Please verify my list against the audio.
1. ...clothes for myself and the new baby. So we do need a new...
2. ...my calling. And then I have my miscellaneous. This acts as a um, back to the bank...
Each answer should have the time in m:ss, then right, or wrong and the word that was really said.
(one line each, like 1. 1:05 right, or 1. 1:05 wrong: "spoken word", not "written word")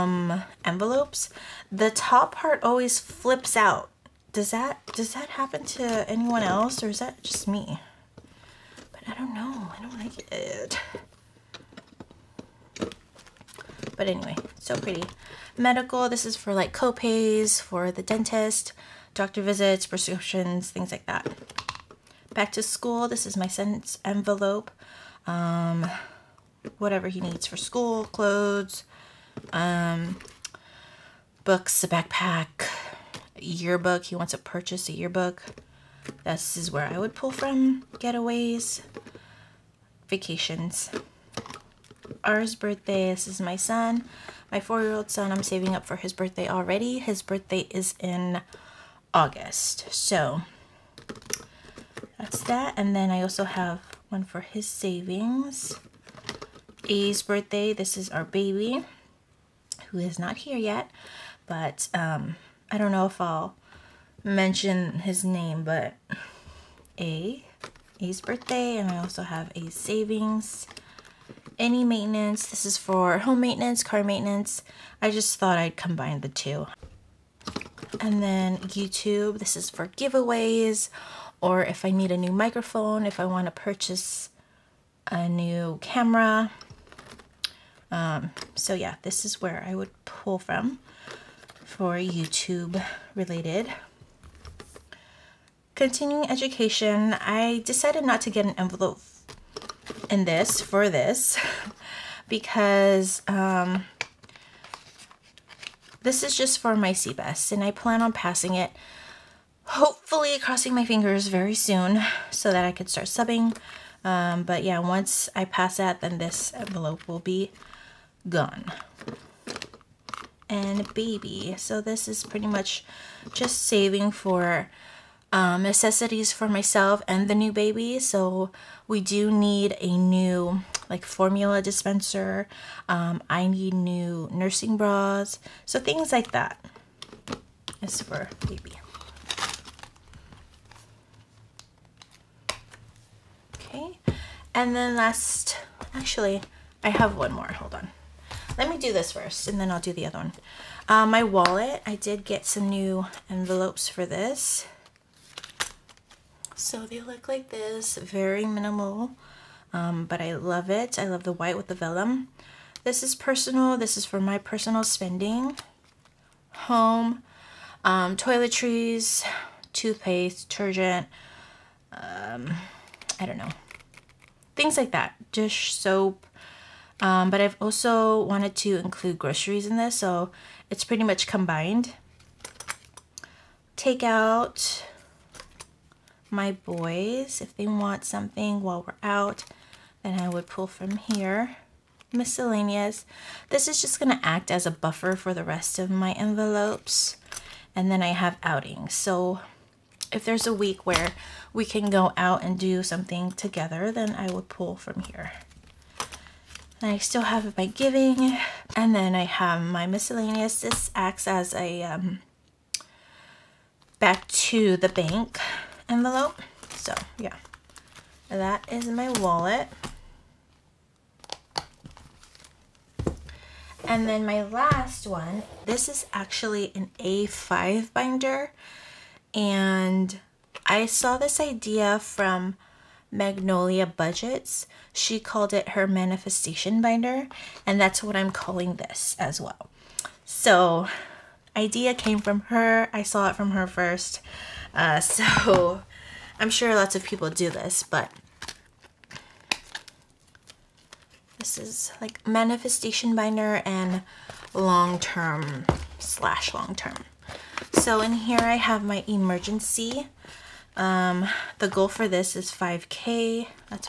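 1. 2:05 wrong: "necessities", not "clothes"
2. 3:27 wrong: "giving", not "calling".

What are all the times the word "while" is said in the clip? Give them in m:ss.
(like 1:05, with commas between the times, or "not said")
3:08.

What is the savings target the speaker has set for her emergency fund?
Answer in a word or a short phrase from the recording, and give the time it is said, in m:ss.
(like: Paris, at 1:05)
5K, at 4:22.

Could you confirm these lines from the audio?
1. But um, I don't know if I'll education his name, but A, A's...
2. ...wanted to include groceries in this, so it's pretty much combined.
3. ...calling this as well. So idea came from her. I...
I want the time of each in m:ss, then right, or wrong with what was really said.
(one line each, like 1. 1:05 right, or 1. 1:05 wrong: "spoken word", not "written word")
1. 1:01 wrong: "mention", not "education"
2. 2:58 right
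3. 3:58 right.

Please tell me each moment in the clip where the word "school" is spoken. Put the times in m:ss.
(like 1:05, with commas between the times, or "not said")
0:22, 0:27.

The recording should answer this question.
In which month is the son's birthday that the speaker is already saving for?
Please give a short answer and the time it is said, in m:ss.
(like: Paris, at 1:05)
August, at 0:49.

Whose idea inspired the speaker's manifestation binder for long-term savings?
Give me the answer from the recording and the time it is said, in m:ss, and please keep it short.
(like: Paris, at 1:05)
Magnolia Budgets, at 3:53.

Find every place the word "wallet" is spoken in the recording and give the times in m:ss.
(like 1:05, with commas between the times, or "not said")
2:31, 3:39.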